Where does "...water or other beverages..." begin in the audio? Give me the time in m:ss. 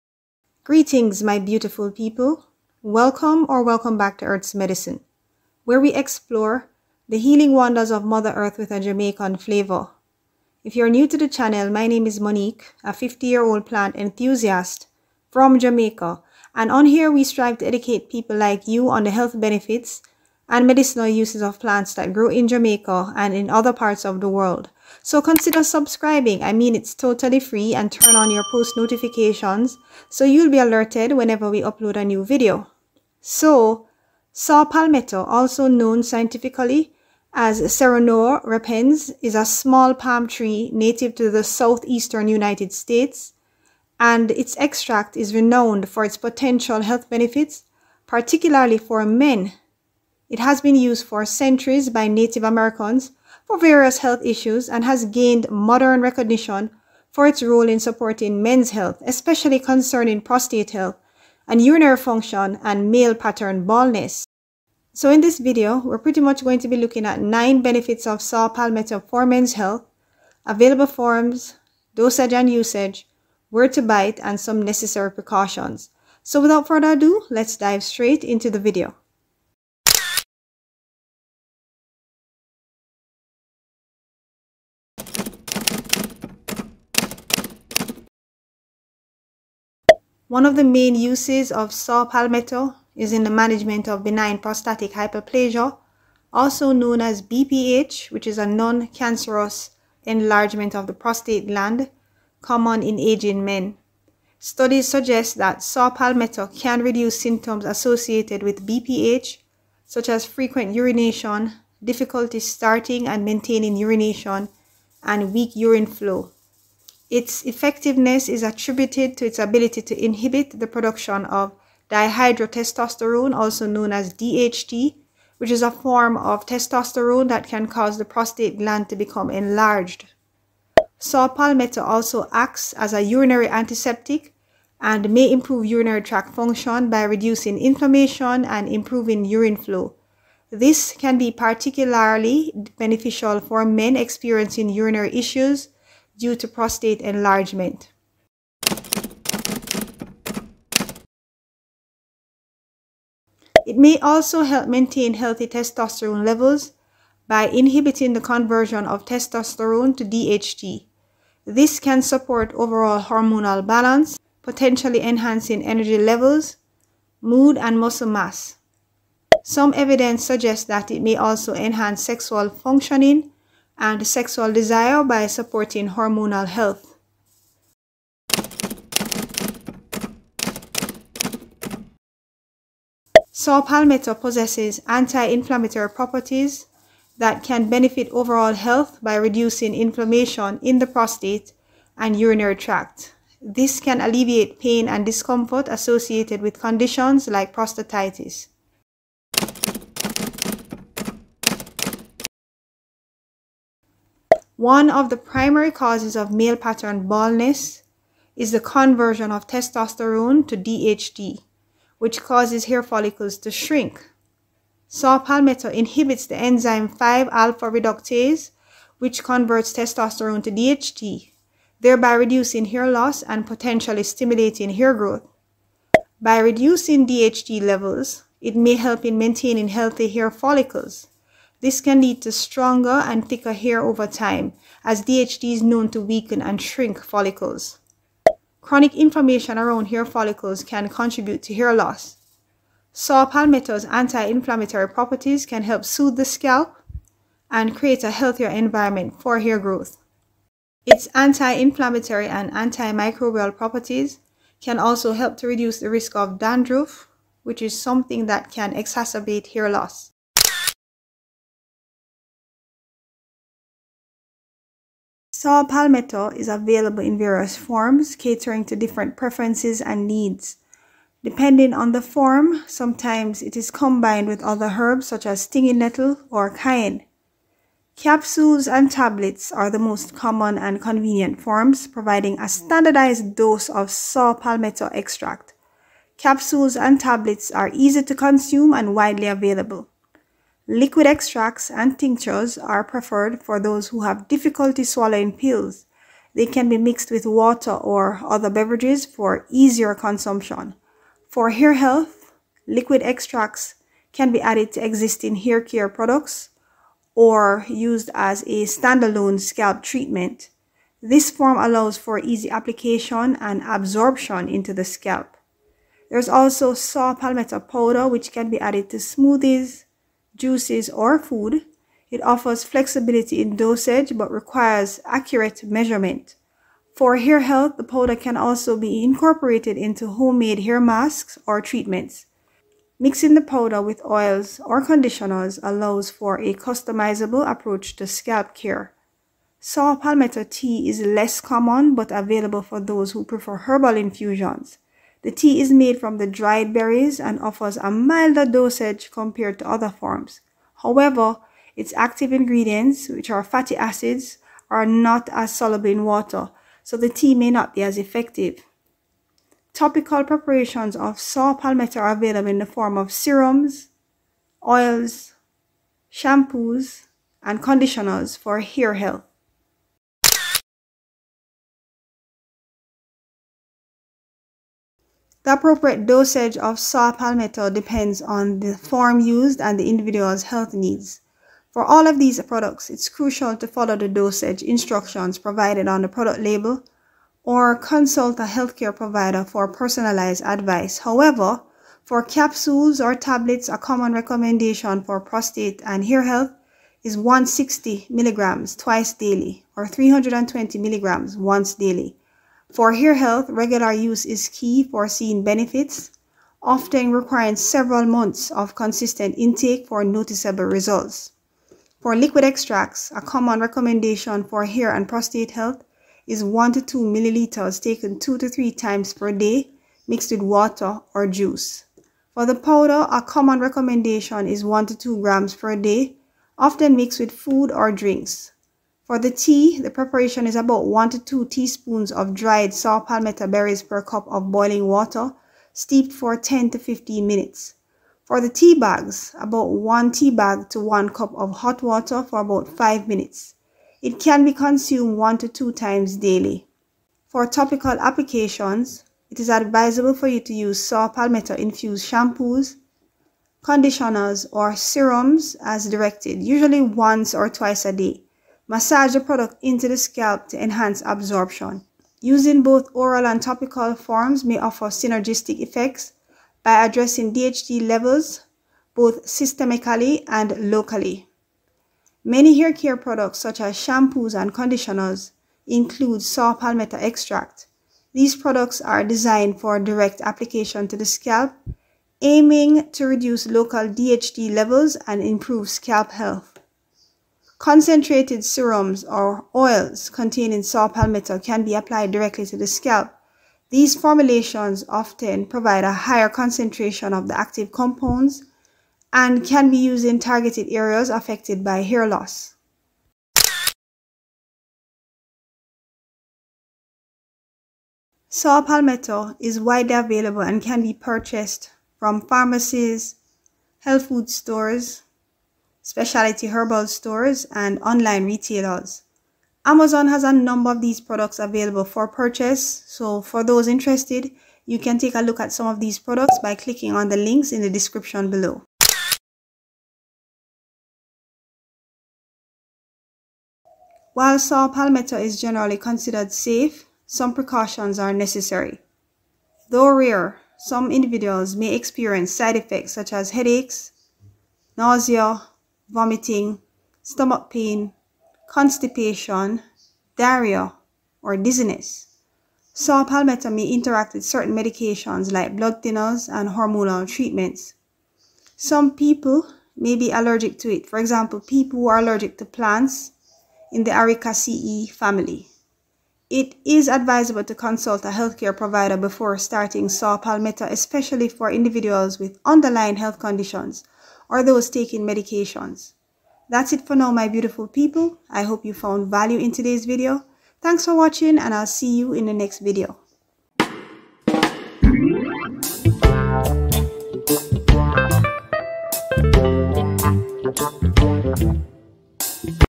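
4:57.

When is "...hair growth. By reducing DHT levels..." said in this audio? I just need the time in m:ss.
3:44.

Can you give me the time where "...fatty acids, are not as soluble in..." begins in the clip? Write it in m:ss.
5:53.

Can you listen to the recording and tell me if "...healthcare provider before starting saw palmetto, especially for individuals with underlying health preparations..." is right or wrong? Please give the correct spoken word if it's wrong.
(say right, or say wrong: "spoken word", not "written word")
wrong: "conditions", not "preparations".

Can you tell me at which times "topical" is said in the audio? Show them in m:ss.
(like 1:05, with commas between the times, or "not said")
5:59, 7:27, 7:43.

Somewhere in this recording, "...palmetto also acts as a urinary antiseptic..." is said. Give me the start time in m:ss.
2:11.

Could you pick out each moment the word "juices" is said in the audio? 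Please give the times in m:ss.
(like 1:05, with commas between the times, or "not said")
5:20, 7:01.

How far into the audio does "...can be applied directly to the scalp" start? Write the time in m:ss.
8:11.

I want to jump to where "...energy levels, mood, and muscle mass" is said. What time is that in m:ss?
2:45.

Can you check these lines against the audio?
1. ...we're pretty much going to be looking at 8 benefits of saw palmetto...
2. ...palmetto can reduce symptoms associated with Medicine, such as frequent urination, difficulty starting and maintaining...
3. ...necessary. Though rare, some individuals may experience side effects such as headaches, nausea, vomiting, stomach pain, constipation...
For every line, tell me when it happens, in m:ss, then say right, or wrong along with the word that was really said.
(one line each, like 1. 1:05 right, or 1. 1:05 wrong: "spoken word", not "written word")
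1. 1:05 wrong: "9", not "8"
2. 1:45 wrong: "BPH", not "Medicine"
3. 8:58 right.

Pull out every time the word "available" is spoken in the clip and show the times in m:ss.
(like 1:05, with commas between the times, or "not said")
1:10, 4:26, 4:49, 5:42, 6:02, 8:29, 8:41.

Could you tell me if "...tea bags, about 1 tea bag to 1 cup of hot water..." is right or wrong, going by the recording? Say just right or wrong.
right.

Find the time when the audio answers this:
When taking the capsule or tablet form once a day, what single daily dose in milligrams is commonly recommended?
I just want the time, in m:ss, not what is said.
6:39.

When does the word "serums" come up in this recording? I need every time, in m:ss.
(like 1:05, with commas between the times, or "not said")
6:03, 7:34, 8:08.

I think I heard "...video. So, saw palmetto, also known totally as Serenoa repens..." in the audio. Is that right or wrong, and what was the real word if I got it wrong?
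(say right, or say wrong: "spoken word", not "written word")
wrong: "scientifically", not "totally".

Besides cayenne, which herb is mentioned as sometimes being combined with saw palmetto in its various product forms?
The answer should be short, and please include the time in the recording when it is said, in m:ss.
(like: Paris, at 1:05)
stinging nettle, at 4:35.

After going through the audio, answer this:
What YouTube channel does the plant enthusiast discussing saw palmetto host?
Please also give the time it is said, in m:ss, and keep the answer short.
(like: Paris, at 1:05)
Earth's Medicine, at 0:04.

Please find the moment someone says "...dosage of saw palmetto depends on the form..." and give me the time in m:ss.
6:16.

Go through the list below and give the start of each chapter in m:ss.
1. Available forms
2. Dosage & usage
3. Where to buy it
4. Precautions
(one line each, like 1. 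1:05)
1. 4:20
2. 6:09
3. 8:23
4. 8:49.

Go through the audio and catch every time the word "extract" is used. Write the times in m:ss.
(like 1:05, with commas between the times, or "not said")
0:44, 4:44, 4:51, 5:03, 6:52, 7:56.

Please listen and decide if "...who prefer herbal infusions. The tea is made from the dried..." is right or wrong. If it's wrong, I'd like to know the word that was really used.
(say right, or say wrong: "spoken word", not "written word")
right.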